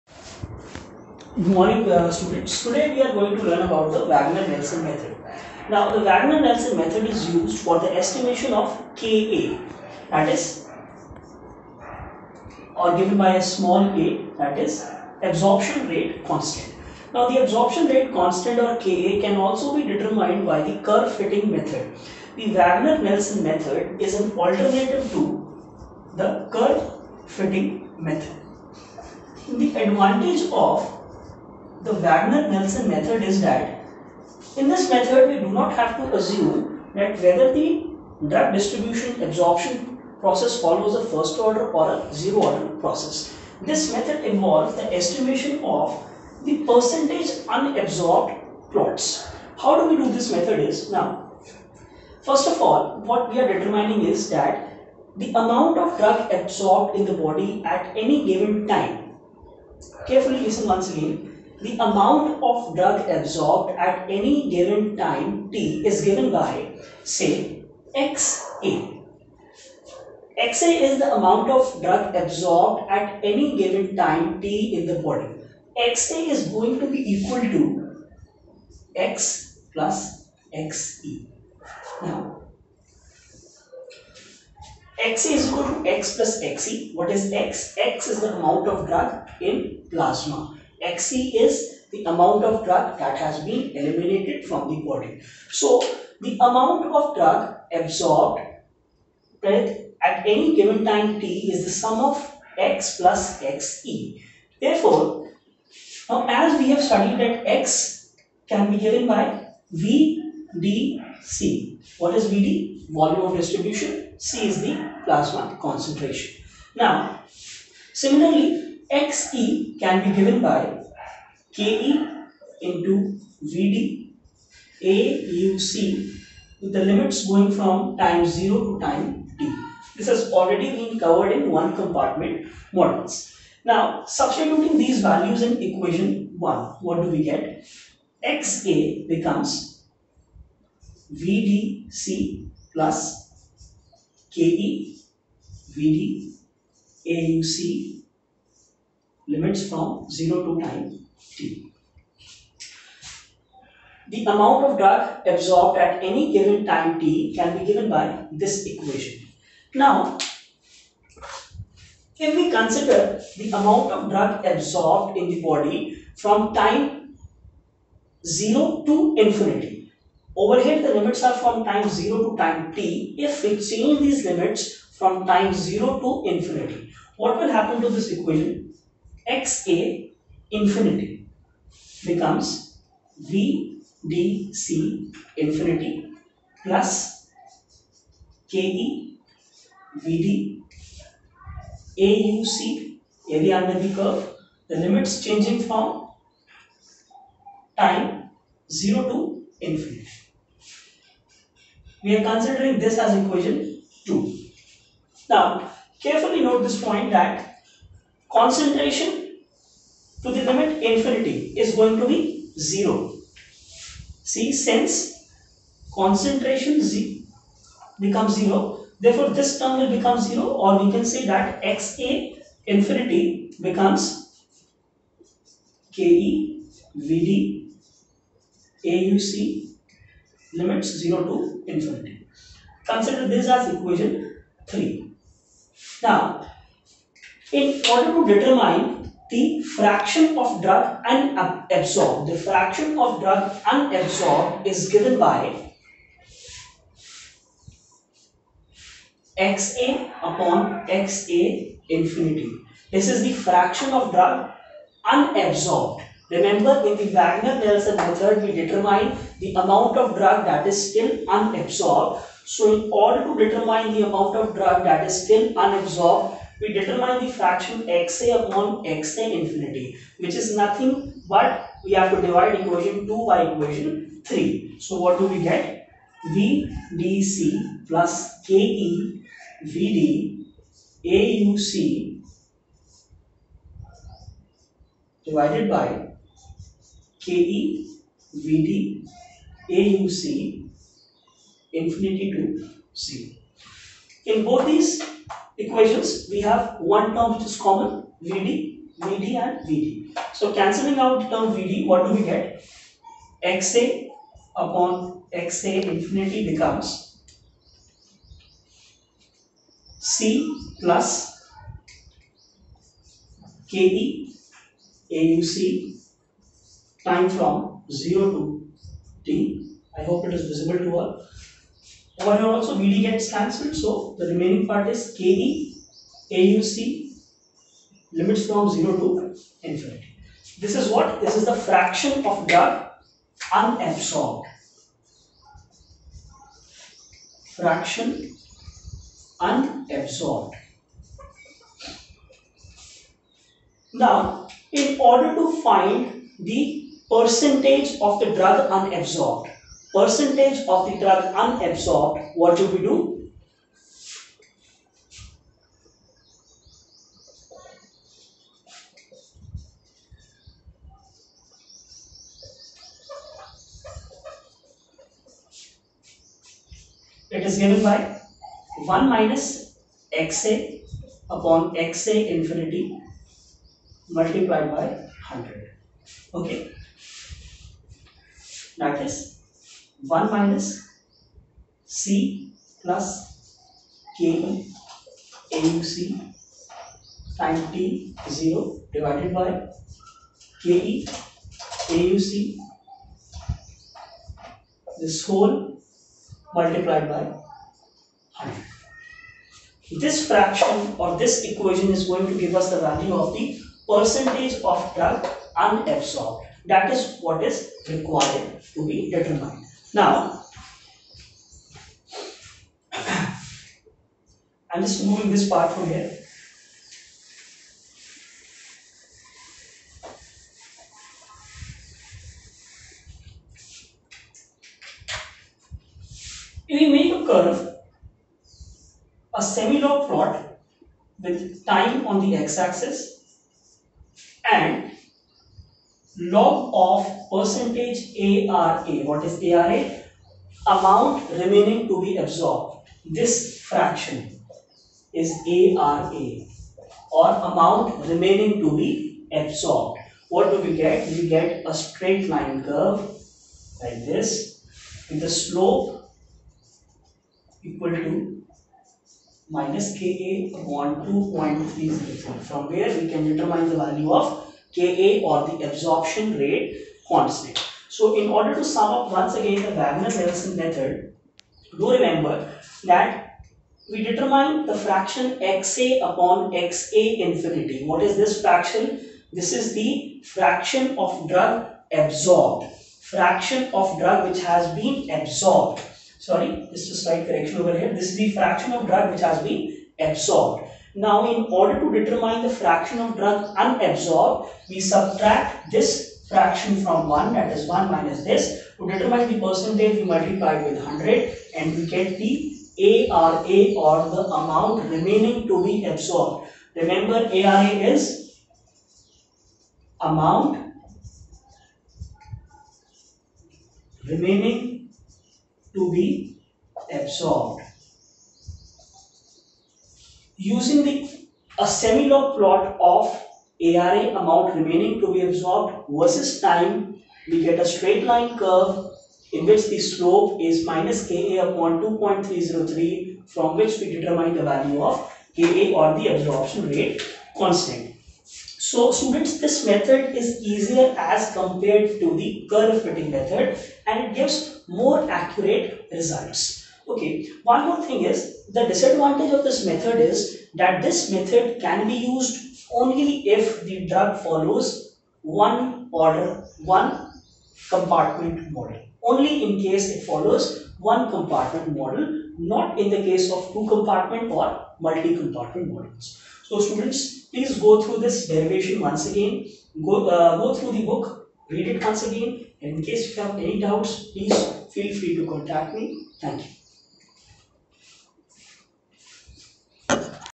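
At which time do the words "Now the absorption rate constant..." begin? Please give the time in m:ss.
0:17.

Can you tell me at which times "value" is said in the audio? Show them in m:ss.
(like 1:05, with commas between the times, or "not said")
2:15, 6:42, 7:43, 8:54.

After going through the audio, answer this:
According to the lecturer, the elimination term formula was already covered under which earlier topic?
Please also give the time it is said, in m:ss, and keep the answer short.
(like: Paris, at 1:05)
One compartment models, at 2:11.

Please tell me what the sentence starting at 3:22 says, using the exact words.
We are considering this as equation 2.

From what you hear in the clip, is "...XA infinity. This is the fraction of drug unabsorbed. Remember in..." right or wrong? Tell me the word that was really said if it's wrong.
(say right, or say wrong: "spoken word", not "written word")
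right.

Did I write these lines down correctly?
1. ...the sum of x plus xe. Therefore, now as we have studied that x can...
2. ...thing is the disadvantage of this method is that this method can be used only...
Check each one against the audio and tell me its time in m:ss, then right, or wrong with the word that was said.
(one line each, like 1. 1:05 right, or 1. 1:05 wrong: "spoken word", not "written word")
1. 1:41 right
2. 9:07 right.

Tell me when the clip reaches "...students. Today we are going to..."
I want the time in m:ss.
0:02.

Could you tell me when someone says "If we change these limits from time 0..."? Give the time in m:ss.
2:53.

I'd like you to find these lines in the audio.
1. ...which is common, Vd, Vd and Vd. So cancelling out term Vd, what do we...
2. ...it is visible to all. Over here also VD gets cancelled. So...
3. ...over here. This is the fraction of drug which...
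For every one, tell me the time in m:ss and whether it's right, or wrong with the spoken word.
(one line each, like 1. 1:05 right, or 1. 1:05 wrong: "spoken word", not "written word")
1. 4:57 right
2. 5:20 right
3. 8:07 right.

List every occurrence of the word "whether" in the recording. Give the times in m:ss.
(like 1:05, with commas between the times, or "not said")
0:37.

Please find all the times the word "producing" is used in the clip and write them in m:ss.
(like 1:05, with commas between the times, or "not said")
not said.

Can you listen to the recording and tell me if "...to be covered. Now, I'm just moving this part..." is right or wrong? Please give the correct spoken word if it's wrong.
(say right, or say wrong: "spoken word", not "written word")
wrong: "determined", not "covered".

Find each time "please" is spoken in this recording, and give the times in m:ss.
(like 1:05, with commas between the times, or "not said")
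9:27, 9:34.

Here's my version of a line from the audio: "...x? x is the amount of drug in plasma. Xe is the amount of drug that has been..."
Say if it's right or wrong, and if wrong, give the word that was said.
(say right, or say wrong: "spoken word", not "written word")
right.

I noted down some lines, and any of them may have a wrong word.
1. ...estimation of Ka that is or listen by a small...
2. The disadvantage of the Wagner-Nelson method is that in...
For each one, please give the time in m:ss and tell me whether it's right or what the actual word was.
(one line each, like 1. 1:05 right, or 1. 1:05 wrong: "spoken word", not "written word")
1. 0:07 wrong: "given", not "listen"
2. 0:29 wrong: "advantage", not "disadvantage".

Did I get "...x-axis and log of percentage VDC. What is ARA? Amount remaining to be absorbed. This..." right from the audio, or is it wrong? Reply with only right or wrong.
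wrong.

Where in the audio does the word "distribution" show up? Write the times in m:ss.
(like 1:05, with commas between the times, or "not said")
0:38, 1:53.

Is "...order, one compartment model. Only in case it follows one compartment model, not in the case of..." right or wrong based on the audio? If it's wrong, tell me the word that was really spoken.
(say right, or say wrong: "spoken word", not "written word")
right.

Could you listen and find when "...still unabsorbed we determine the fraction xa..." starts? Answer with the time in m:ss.
4:25.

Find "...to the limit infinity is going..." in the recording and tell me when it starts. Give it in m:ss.
3:30.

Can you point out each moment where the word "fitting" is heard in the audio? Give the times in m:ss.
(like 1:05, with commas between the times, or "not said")
0:21, 0:27, 9:02.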